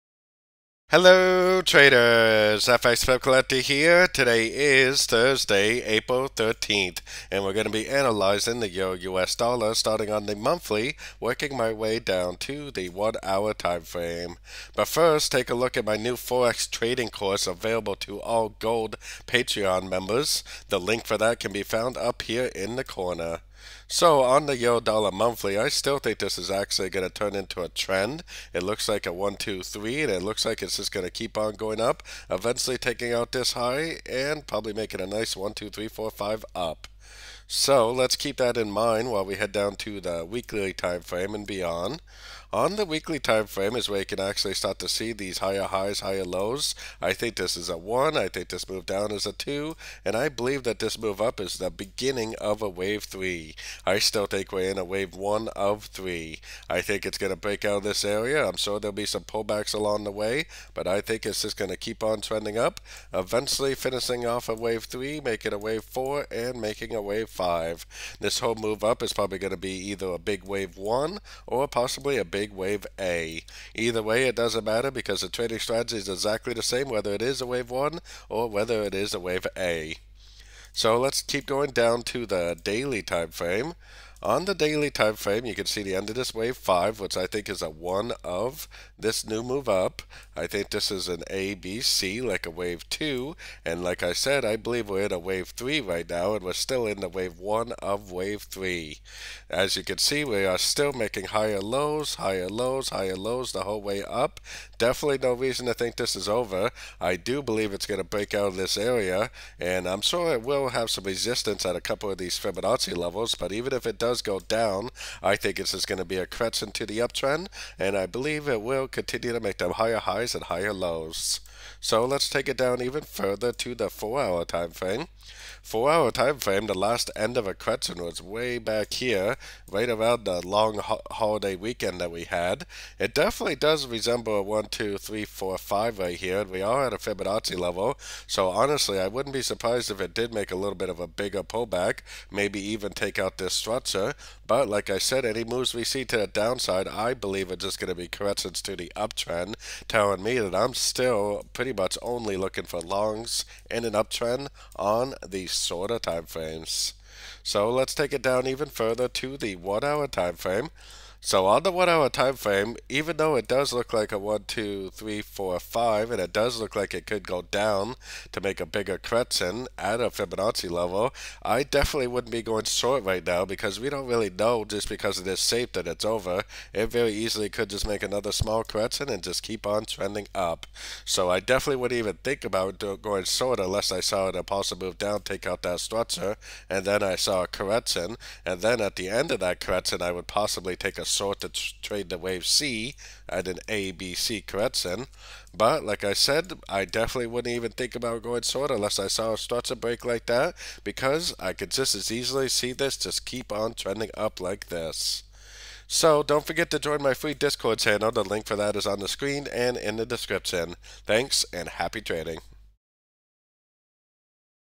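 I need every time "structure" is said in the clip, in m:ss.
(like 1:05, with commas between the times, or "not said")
2:23, 3:05.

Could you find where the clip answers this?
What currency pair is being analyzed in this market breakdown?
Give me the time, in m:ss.
0:08.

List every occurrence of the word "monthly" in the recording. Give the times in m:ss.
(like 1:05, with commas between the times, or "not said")
0:10, 0:25.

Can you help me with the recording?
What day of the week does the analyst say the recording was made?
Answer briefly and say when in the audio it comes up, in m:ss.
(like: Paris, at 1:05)
Thursday, at 0:05.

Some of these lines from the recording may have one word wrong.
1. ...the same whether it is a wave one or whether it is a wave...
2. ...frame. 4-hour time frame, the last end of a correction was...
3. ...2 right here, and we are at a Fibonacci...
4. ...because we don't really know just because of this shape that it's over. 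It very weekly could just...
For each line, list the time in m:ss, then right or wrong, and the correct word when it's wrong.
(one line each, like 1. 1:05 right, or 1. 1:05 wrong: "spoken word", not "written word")
1. 1:16 right
2. 2:04 right
3. 2:15 wrong: "5", not "2"
4. 2:53 wrong: "easily", not "weekly".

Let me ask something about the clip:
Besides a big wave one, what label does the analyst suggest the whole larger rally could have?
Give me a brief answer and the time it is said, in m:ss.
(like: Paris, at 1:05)
a big wave A, at 1:12.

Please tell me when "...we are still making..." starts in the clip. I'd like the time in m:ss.
1:40.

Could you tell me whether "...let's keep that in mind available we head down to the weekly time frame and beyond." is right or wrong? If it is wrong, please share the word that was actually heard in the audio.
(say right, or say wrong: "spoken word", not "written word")
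wrong: "while", not "available".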